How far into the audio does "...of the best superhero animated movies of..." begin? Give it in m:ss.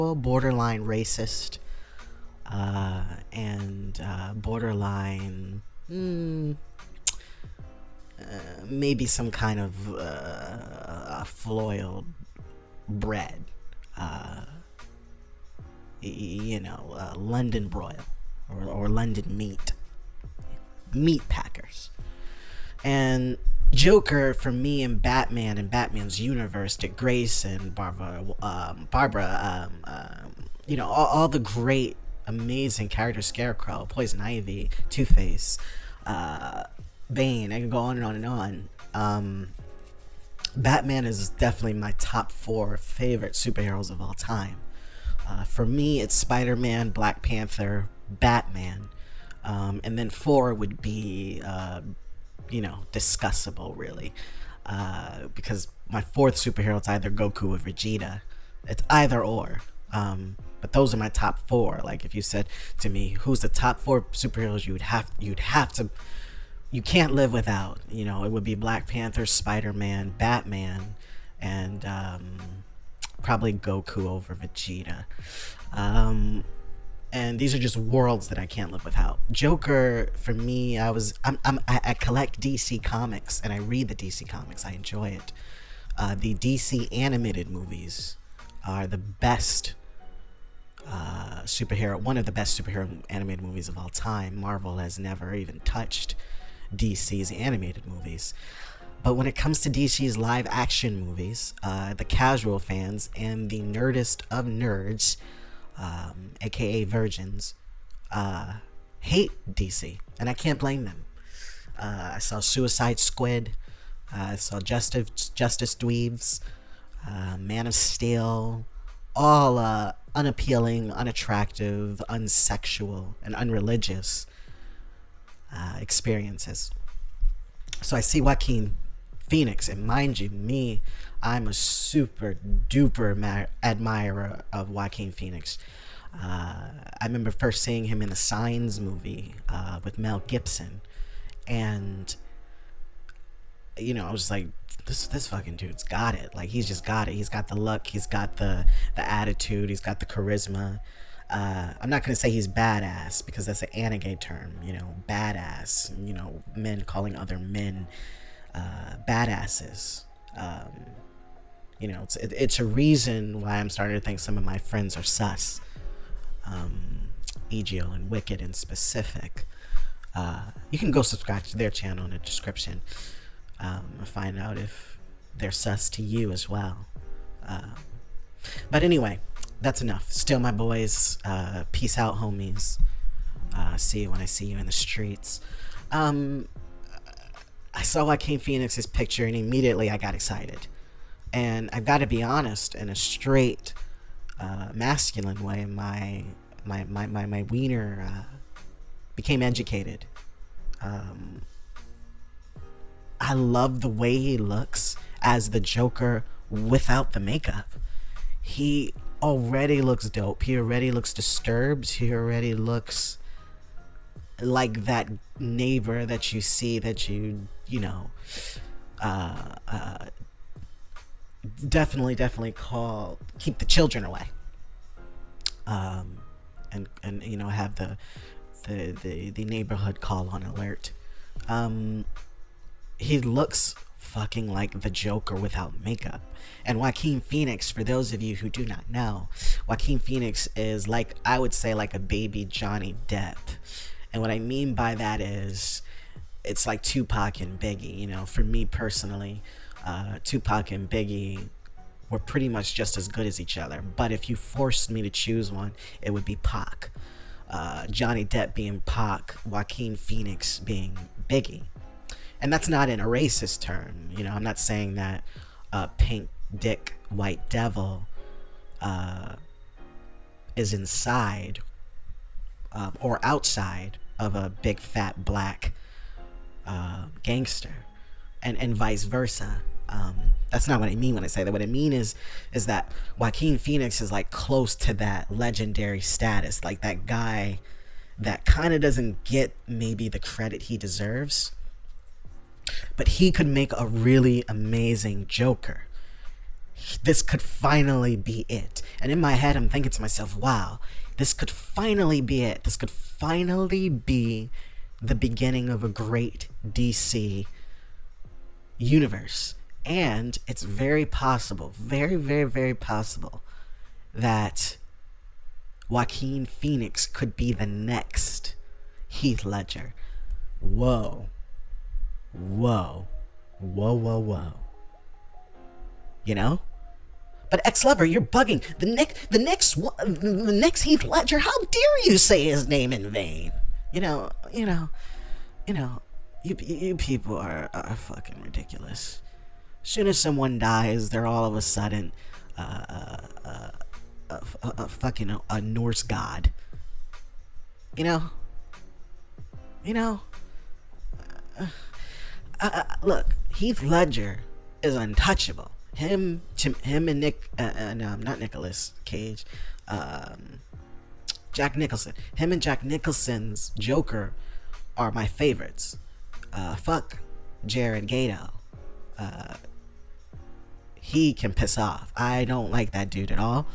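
1:32.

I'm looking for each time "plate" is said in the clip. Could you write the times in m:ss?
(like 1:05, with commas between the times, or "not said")
not said.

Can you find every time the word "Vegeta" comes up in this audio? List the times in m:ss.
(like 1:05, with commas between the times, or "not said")
0:57, 1:14.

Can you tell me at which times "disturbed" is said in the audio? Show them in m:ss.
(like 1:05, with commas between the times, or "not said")
3:31.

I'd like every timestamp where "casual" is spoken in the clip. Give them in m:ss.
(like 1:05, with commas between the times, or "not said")
1:42.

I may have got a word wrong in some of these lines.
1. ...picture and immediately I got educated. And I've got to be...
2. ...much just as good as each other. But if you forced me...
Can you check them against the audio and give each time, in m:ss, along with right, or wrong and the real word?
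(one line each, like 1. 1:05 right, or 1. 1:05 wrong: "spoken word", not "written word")
1. 3:08 wrong: "excited", not "educated"
2. 4:12 right.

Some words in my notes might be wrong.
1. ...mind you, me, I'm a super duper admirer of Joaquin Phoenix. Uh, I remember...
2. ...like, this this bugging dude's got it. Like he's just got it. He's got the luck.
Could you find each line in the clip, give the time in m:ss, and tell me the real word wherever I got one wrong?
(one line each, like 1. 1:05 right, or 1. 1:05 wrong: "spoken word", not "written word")
1. 2:09 right
2. 2:24 wrong: "fucking", not "bugging".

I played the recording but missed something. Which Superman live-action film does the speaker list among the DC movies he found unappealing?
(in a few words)
Man of Steel.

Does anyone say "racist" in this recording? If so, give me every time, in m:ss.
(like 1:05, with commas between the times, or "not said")
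0:00, 4:23.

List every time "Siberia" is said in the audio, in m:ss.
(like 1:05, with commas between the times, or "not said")
not said.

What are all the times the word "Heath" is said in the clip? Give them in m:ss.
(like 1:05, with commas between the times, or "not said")
5:19, 5:30, 5:53.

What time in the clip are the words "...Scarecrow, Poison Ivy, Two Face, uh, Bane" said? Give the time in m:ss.
0:33.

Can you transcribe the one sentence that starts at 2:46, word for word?
Um, EGL and Wicked in specific.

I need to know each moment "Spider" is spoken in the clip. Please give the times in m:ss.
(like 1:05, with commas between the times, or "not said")
0:46, 1:09.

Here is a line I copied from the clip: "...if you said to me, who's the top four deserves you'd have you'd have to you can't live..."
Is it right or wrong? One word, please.
wrong.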